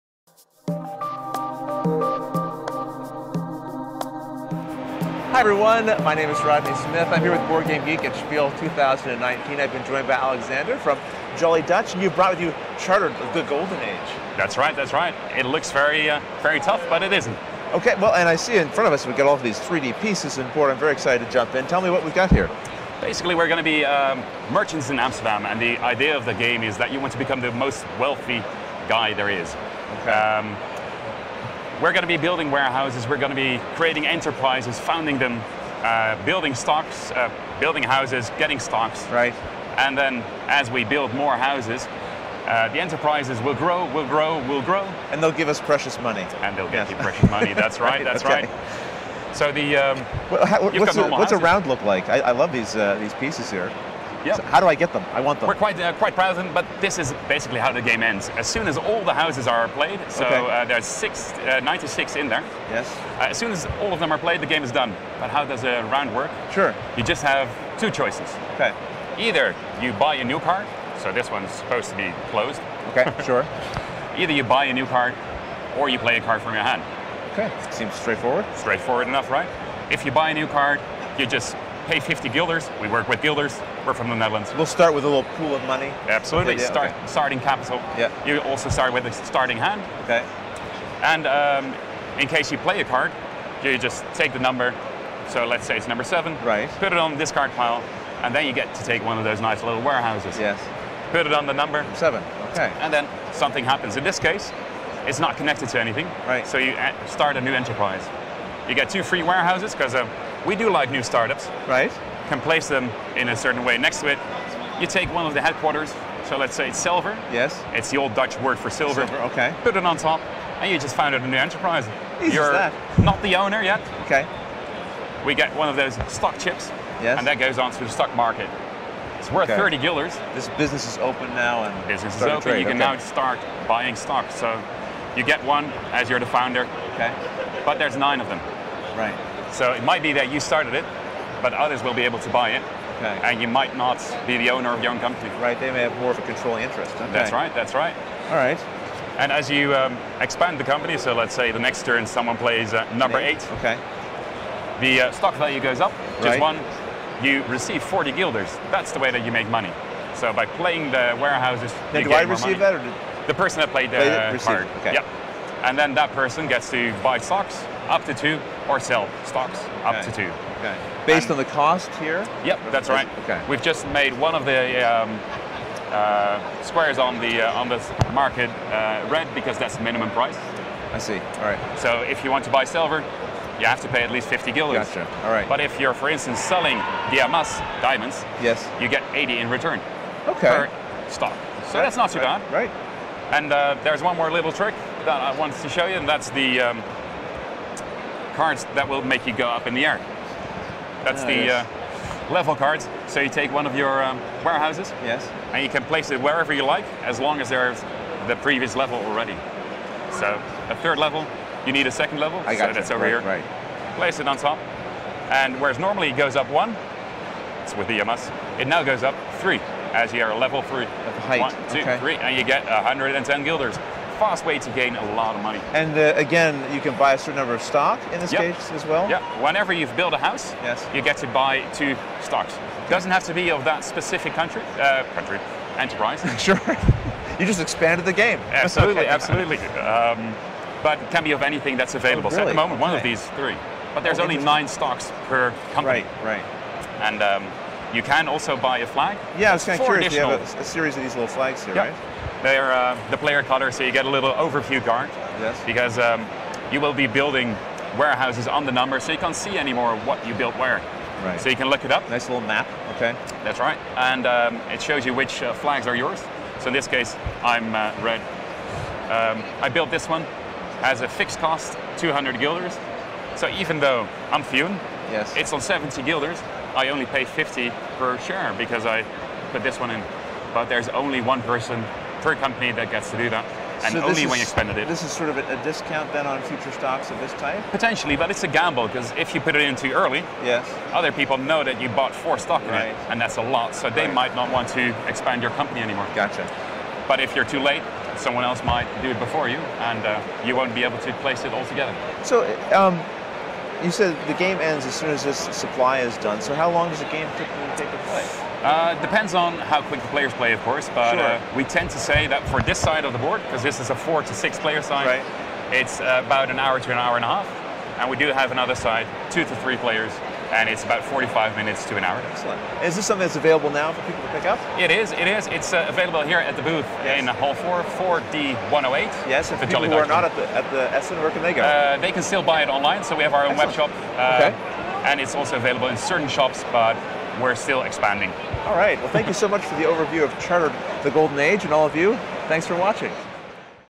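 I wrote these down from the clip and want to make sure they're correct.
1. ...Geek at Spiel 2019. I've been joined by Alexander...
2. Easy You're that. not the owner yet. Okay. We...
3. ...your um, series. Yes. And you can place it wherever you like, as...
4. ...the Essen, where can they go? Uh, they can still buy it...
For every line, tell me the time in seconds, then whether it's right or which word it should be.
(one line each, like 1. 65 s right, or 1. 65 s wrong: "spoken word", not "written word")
1. 7 s right
2. 122 s right
3. 203 s wrong: "warehouses", not "series"
4. 330 s right.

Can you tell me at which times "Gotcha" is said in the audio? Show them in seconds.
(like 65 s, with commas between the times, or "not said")
184 s, 296 s.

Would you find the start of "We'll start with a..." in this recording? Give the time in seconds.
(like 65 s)
84 s.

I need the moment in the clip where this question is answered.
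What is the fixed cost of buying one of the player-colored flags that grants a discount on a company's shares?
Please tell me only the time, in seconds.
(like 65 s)
271 s.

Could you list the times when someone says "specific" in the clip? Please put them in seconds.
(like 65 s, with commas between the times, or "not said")
233 s.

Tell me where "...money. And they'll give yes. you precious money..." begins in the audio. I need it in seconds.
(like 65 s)
46 s.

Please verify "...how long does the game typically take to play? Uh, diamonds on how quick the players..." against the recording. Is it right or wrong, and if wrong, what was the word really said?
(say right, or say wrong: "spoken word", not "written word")
wrong: "depends", not "diamonds".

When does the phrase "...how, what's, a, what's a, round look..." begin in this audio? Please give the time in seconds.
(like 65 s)
50 s.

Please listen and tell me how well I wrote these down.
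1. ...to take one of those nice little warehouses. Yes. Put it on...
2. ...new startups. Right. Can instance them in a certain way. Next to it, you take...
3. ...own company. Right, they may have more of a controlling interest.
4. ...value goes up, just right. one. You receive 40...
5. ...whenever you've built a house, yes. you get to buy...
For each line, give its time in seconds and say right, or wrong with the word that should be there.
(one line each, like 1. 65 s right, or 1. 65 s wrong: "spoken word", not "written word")
1. 98 s right
2. 110 s wrong: "place", not "instance"
3. 144 s right
4. 155 s right
5. 229 s right.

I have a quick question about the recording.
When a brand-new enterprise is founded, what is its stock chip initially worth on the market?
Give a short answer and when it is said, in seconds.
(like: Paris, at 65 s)
30 guilders, at 129 s.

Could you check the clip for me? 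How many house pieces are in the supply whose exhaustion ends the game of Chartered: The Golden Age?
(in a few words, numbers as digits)
96.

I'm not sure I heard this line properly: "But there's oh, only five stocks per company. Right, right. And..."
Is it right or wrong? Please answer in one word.
wrong.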